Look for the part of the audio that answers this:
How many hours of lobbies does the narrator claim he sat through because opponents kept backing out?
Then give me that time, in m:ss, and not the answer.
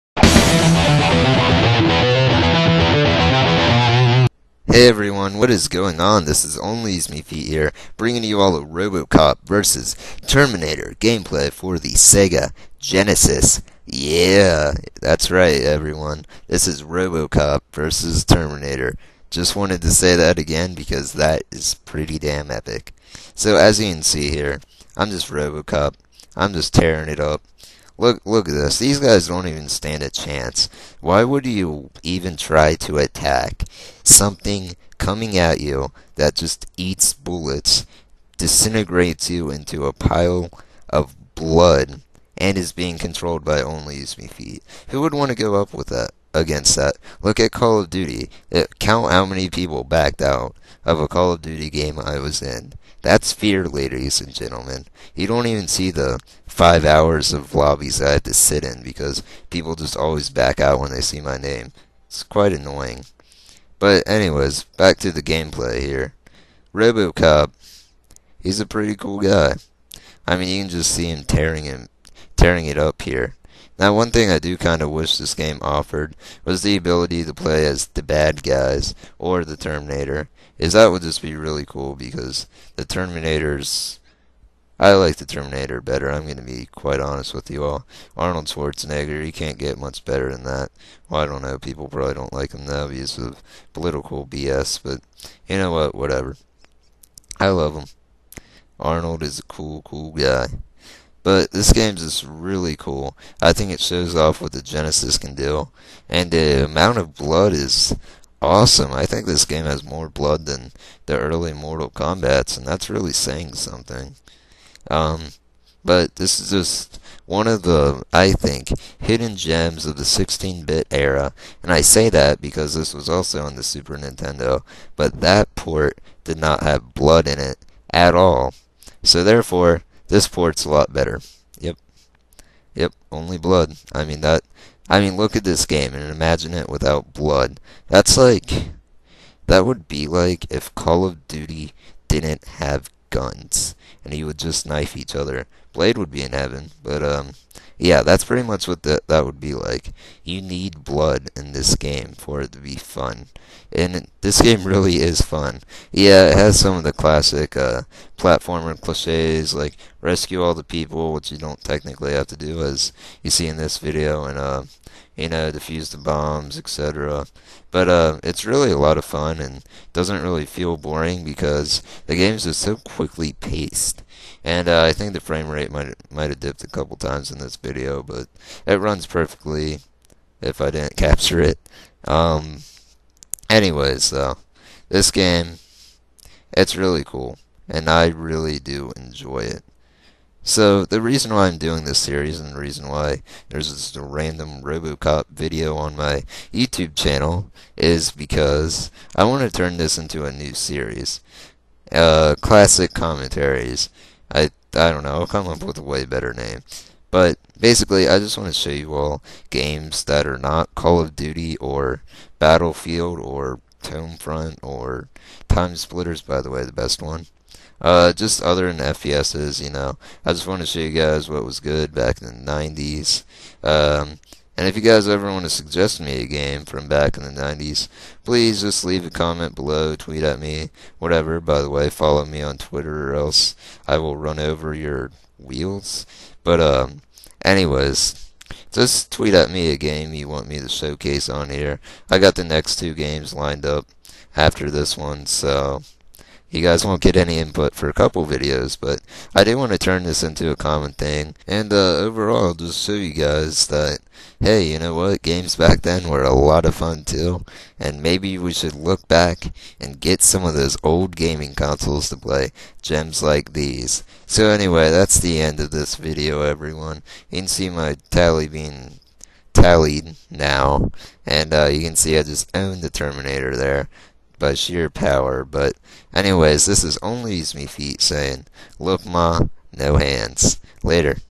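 0:56.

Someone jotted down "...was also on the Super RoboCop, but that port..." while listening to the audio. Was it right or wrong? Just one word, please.
wrong.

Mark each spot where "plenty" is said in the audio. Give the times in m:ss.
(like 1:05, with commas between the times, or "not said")
not said.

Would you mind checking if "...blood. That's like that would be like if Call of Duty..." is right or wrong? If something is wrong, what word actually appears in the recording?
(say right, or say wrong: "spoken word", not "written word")
right.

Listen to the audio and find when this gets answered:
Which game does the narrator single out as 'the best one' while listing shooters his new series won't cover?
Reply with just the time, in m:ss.
3:35.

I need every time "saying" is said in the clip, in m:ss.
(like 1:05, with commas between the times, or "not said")
1:53, 4:38.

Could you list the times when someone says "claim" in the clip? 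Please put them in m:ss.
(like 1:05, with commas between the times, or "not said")
not said.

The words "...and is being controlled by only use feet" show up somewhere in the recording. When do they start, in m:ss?
0:42.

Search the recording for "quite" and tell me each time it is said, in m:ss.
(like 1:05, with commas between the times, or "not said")
1:02, 1:26.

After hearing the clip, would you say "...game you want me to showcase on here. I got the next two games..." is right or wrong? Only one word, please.
right.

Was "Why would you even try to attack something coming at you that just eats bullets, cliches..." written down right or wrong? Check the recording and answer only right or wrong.
wrong.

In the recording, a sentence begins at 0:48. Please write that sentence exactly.
It, count how many people backed out of a Call of Duty game I was in.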